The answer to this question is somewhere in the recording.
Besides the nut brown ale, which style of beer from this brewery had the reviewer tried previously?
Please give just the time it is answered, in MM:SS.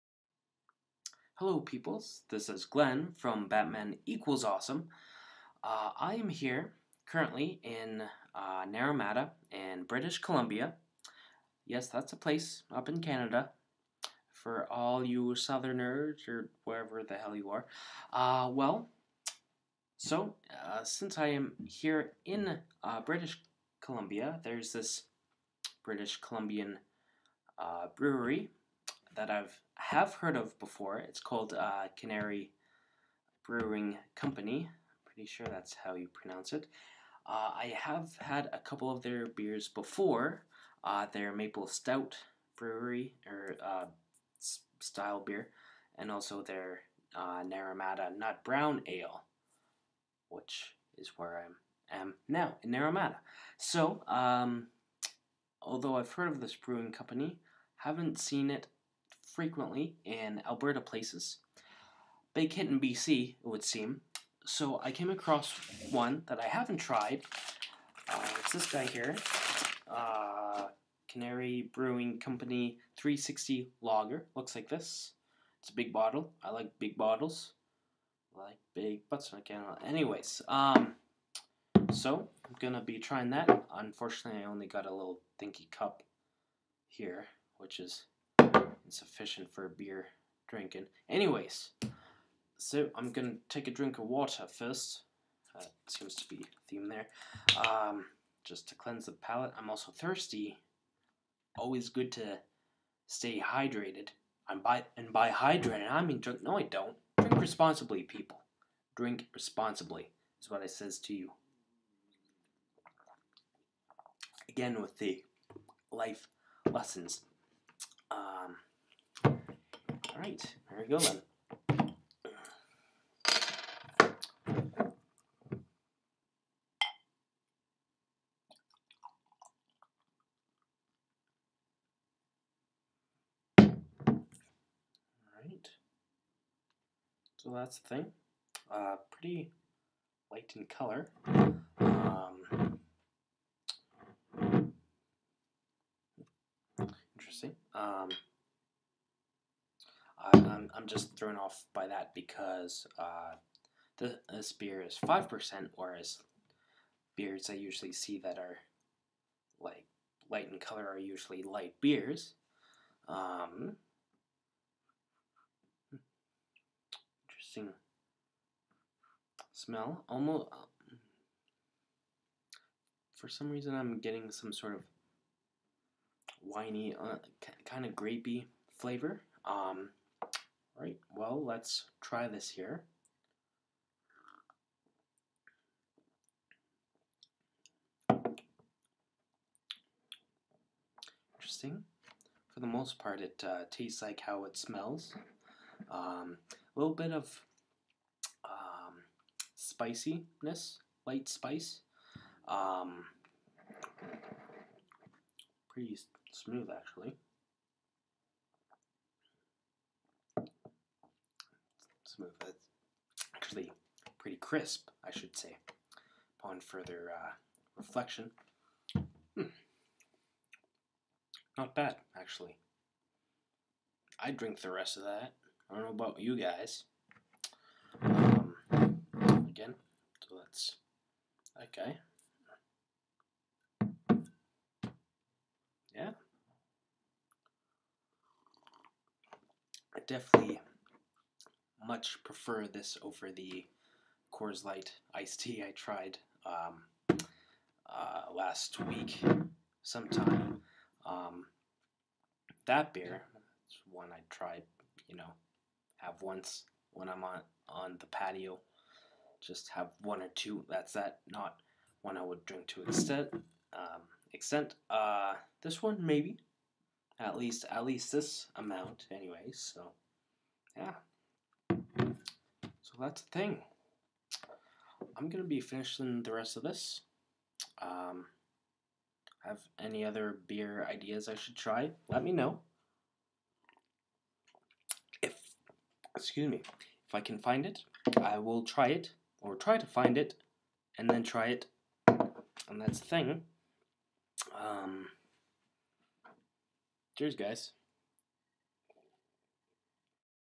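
00:41.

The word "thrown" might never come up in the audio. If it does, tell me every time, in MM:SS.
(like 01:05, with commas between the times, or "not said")
02:31.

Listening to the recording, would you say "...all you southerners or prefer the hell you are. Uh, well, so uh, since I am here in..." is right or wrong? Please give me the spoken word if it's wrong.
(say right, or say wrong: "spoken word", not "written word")
wrong: "wherever", not "prefer".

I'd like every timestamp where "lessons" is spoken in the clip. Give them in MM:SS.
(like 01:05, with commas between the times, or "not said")
01:56.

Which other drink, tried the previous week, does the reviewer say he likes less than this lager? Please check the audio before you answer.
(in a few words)
Coors Light iced tea.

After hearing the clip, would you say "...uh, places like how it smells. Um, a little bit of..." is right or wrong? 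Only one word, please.
wrong.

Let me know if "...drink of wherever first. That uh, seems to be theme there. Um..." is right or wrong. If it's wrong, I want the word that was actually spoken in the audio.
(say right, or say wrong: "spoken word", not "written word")
wrong: "water", not "wherever".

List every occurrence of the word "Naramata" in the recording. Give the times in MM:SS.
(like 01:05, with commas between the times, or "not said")
00:08, 00:47, 00:52.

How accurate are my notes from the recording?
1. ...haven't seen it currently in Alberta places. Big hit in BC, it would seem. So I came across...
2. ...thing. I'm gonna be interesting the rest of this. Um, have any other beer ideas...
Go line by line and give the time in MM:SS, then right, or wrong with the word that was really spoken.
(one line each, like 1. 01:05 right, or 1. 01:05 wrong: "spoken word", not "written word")
1. 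00:57 wrong: "frequently", not "currently"
2. 04:33 wrong: "finishing", not "interesting".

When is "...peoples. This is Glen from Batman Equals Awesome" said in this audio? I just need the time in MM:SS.
00:01.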